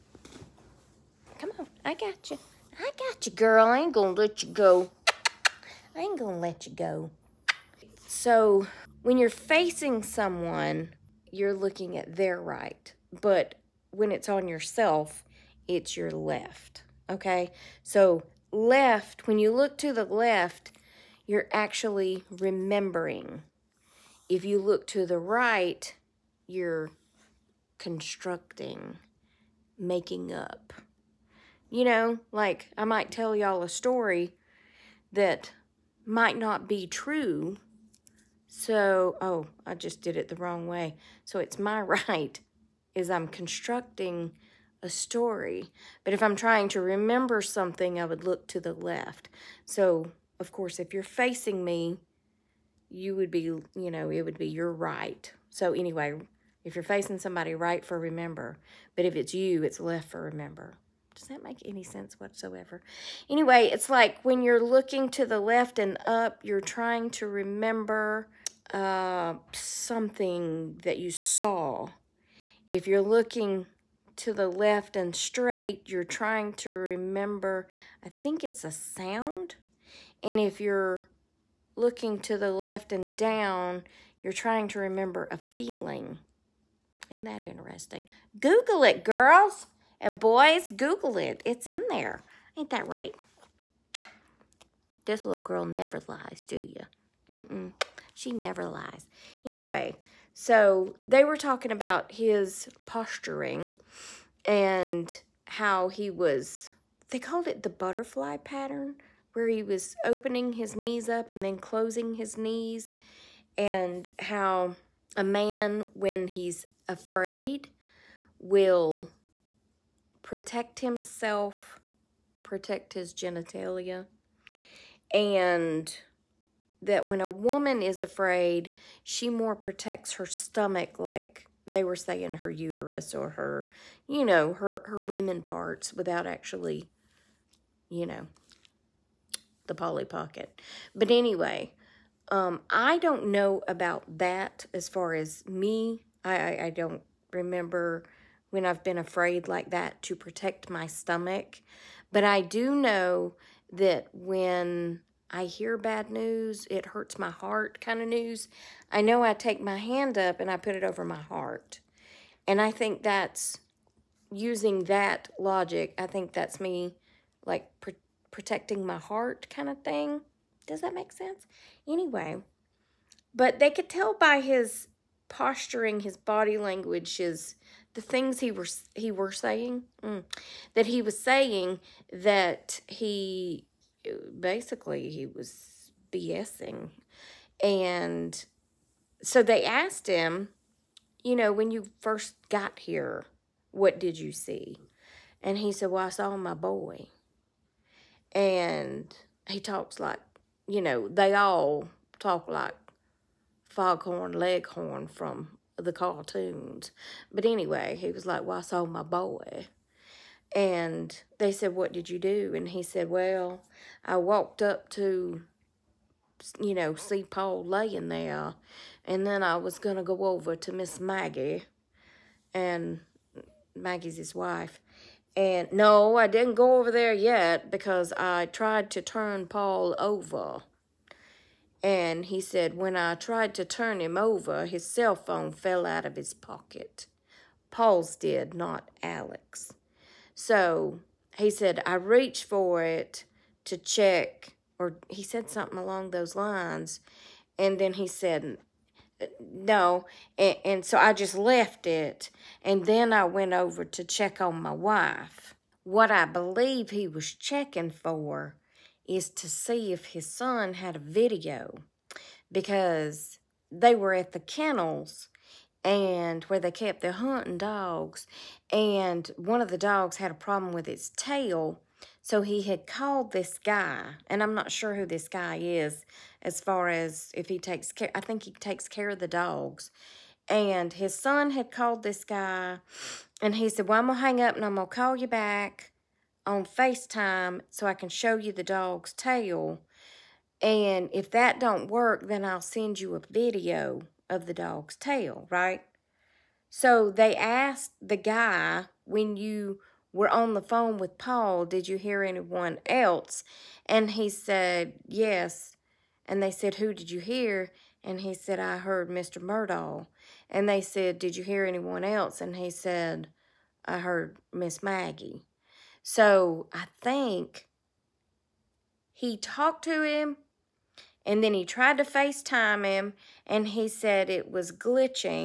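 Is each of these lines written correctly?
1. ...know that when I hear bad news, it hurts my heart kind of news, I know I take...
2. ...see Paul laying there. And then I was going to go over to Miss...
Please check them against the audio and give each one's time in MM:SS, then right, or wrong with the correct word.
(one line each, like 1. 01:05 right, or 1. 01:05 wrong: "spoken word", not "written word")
1. 02:32 right
2. 03:36 right.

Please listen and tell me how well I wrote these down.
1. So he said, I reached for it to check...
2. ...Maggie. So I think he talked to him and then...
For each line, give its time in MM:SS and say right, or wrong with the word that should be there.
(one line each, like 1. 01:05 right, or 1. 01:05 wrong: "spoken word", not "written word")
1. 04:00 right
2. 05:14 right.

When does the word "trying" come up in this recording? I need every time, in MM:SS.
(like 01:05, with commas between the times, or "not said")
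00:46, 01:06, 01:16, 01:24.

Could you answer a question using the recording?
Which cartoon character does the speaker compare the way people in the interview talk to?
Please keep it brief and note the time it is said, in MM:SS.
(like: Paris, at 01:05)
Foghorn Leghorn, at 03:23.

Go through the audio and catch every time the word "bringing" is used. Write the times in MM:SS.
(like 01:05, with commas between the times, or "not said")
not said.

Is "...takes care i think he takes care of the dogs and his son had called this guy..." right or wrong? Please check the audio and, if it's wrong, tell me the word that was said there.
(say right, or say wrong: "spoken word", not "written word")
right.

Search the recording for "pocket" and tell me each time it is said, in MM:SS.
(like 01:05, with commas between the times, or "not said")
02:20, 03:56.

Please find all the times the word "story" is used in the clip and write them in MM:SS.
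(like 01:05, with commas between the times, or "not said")
00:33, 00:44.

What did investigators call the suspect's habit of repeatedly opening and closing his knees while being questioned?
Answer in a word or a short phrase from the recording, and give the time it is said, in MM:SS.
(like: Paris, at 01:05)
Butterfly pattern, at 01:47.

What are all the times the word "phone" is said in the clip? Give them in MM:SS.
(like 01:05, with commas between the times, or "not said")
03:55, 05:00.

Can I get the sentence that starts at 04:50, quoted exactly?
And if that don't work, then I'll send you a video of the dog's tail, right?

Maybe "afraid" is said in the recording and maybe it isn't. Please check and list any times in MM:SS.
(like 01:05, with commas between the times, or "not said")
01:56, 02:08, 02:28.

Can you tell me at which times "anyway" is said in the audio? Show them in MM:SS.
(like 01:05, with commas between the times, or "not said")
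00:55, 01:03, 01:39, 02:21, 02:51, 03:27.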